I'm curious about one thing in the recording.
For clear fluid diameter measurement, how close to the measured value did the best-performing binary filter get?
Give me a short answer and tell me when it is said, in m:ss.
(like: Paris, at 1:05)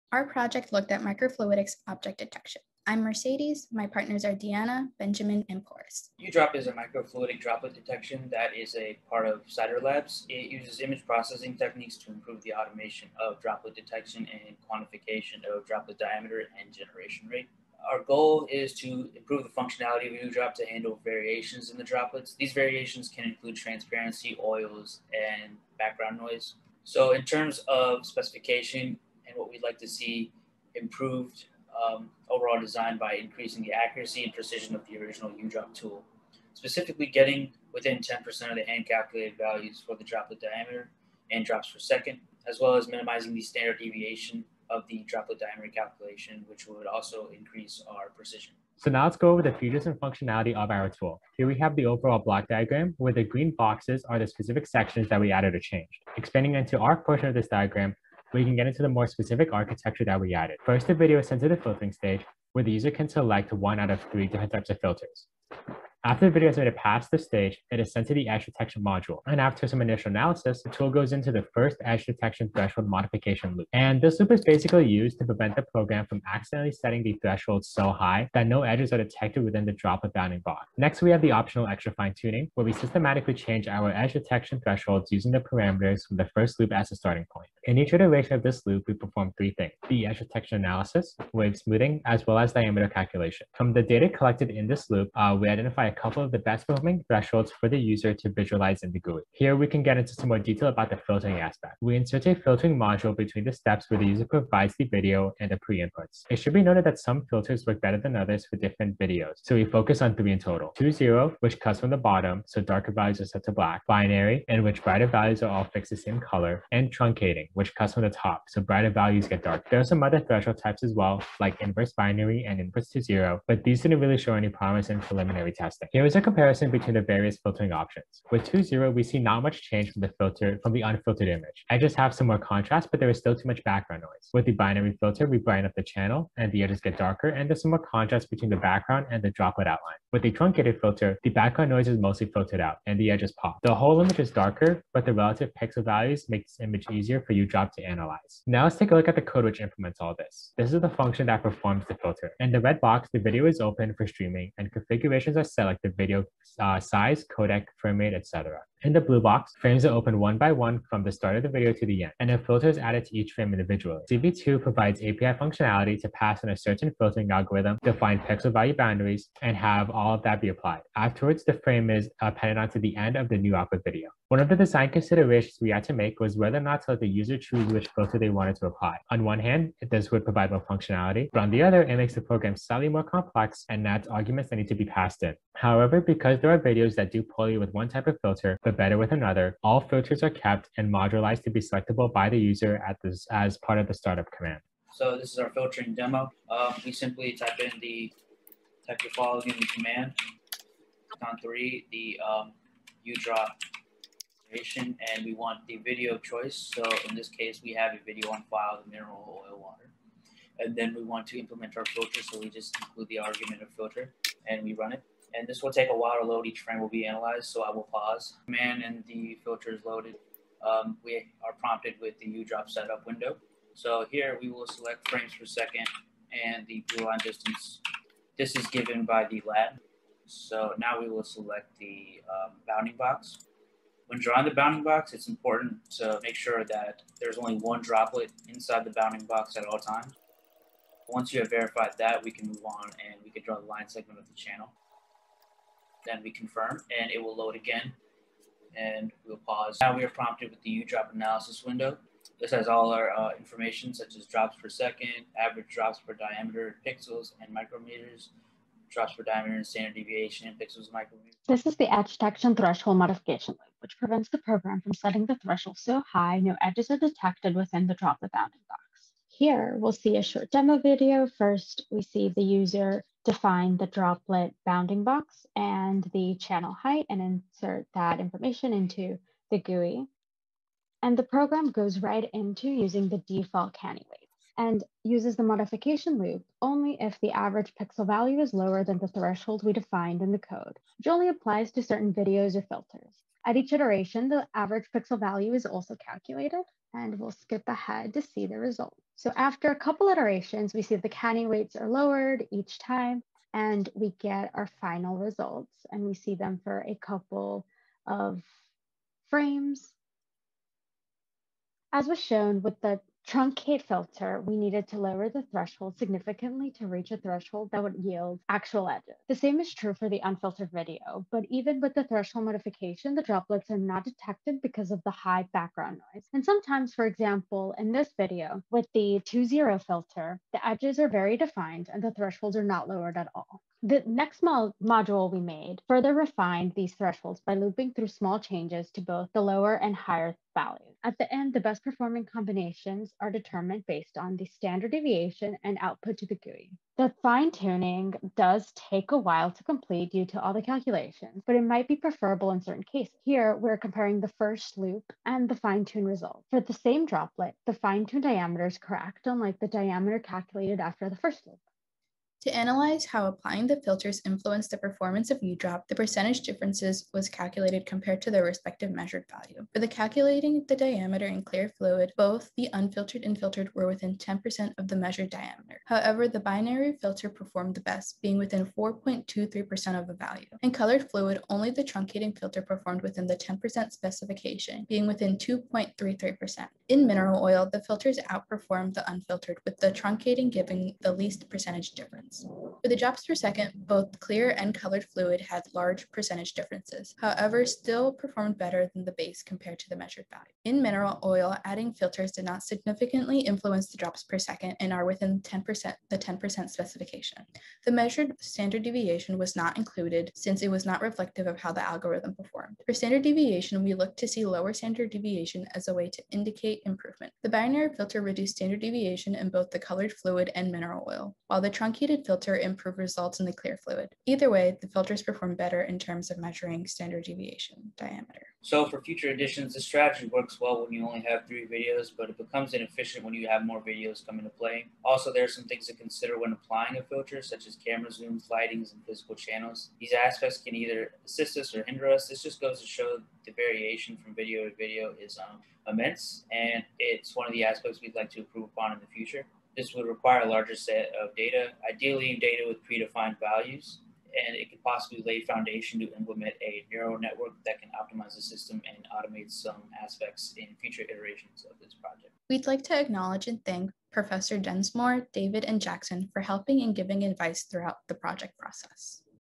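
4.23%, at 6:18.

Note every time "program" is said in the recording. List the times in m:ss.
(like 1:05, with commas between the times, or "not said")
1:15, 3:02, 4:24, 4:41.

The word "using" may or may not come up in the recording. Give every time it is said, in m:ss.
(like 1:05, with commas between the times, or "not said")
1:25, 4:42.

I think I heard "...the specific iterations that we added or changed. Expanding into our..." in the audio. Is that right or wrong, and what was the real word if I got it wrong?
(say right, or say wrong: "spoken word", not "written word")
wrong: "sections", not "iterations".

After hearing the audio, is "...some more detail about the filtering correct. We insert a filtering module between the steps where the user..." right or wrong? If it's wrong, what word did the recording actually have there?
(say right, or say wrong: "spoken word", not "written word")
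wrong: "aspect", not "correct".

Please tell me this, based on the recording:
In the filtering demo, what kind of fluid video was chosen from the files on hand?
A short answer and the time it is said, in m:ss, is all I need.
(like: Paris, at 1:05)
mineral oil water, at 3:28.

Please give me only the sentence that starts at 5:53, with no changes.
Here, we're comparing the first loop and the fine tune result.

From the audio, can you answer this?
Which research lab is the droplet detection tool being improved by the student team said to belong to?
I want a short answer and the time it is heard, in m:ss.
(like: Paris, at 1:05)
CIDAR Labs, at 0:09.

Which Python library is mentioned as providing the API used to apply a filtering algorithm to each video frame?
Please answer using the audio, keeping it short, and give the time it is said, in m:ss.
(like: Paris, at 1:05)
CV2, at 2:44.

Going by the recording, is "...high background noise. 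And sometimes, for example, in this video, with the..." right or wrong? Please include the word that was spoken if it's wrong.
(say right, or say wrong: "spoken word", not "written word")
right.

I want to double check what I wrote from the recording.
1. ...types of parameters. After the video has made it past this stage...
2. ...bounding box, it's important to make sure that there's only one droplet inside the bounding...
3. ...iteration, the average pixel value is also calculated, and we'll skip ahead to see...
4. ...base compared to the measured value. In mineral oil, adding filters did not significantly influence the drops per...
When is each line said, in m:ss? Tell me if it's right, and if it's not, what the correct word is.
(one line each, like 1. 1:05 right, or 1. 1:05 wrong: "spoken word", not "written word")
1. 1:04 wrong: "filters", not "parameters"
2. 3:54 right
3. 4:53 right
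4. 6:39 right.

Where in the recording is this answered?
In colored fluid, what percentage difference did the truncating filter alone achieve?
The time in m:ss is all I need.
6:25.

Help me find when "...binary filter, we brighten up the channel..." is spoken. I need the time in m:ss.
2:14.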